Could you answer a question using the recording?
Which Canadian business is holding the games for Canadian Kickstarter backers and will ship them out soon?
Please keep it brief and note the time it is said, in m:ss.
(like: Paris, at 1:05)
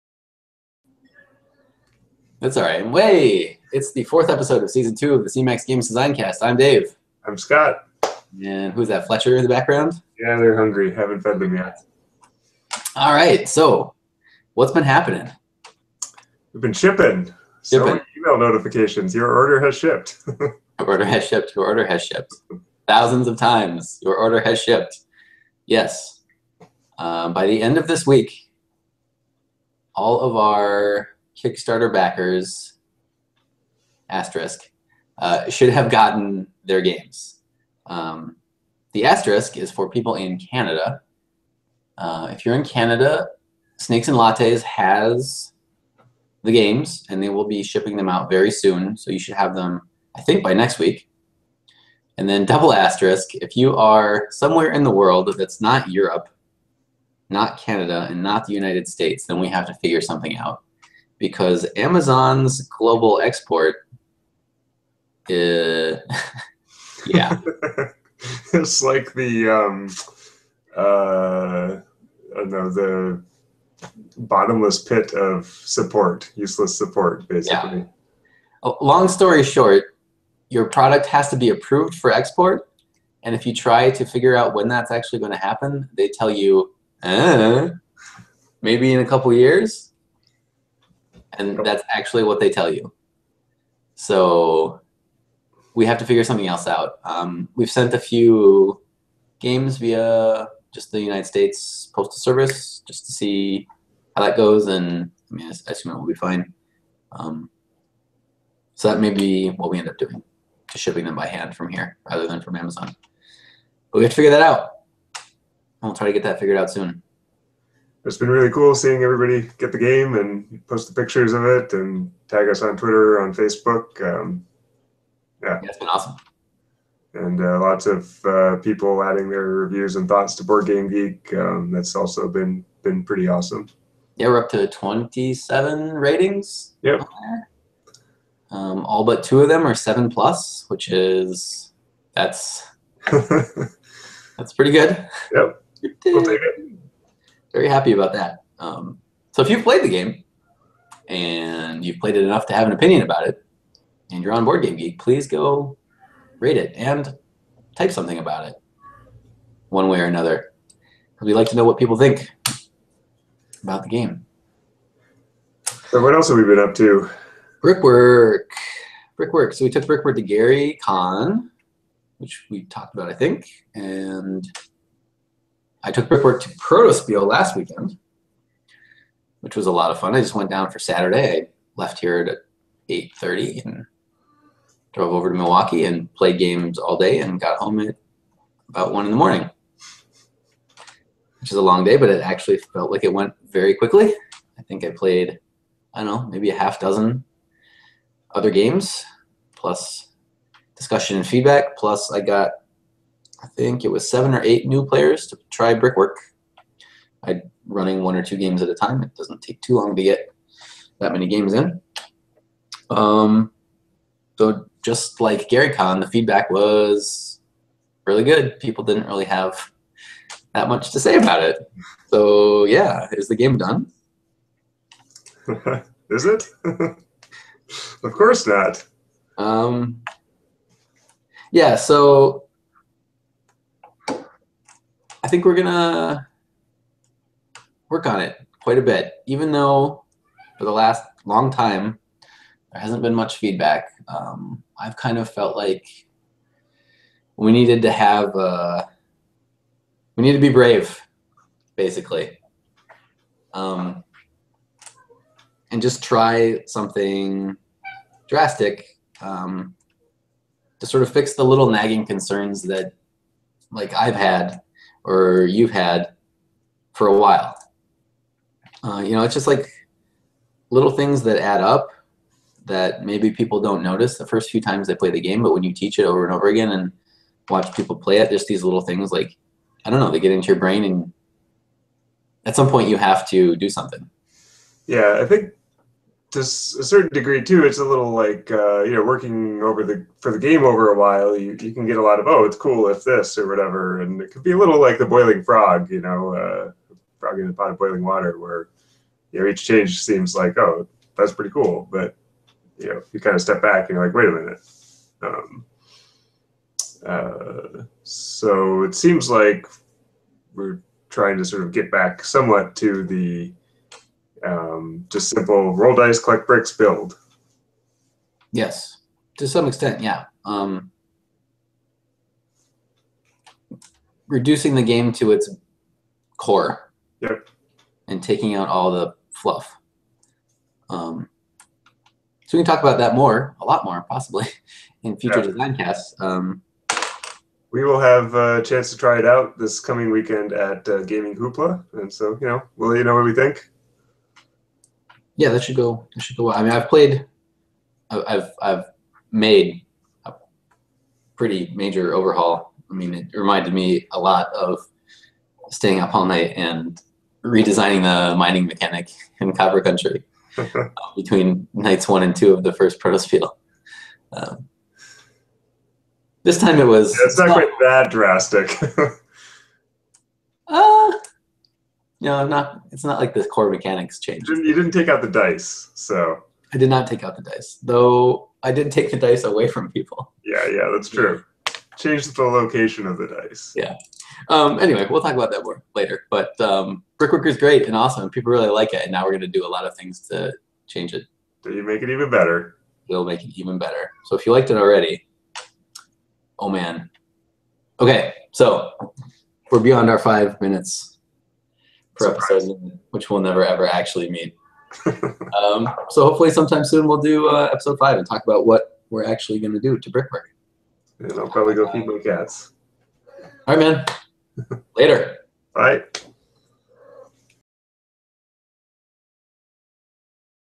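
Snakes and Lattes, at 0:43.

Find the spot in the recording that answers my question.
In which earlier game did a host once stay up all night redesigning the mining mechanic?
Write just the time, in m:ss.
5:59.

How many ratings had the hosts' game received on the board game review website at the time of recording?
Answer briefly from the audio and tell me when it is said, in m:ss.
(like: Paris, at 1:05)
27, at 2:14.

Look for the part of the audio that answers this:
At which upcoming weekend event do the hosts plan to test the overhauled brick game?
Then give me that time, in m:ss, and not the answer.
5:41.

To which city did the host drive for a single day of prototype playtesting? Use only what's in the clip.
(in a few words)
Milwaukee.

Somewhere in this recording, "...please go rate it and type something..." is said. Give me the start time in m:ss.
2:34.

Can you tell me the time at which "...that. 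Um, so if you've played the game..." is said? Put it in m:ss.
2:28.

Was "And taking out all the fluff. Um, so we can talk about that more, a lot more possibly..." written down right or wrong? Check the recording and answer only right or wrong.
right.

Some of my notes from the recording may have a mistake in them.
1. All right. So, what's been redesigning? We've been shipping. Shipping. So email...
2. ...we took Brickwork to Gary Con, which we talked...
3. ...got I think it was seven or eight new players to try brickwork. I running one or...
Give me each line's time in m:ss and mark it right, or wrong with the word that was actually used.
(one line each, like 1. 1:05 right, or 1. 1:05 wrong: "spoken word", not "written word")
1. 0:12 wrong: "happening", not "redesigning"
2. 2:49 right
3. 3:22 right.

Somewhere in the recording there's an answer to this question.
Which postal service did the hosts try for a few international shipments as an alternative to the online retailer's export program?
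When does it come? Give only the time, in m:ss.
1:41.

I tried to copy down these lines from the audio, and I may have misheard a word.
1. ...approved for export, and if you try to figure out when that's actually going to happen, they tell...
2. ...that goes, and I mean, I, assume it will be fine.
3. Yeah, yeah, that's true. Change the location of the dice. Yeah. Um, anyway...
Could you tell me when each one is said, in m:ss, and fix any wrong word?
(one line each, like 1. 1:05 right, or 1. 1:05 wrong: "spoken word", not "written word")
1. 1:21 right
2. 1:44 right
3. 6:20 right.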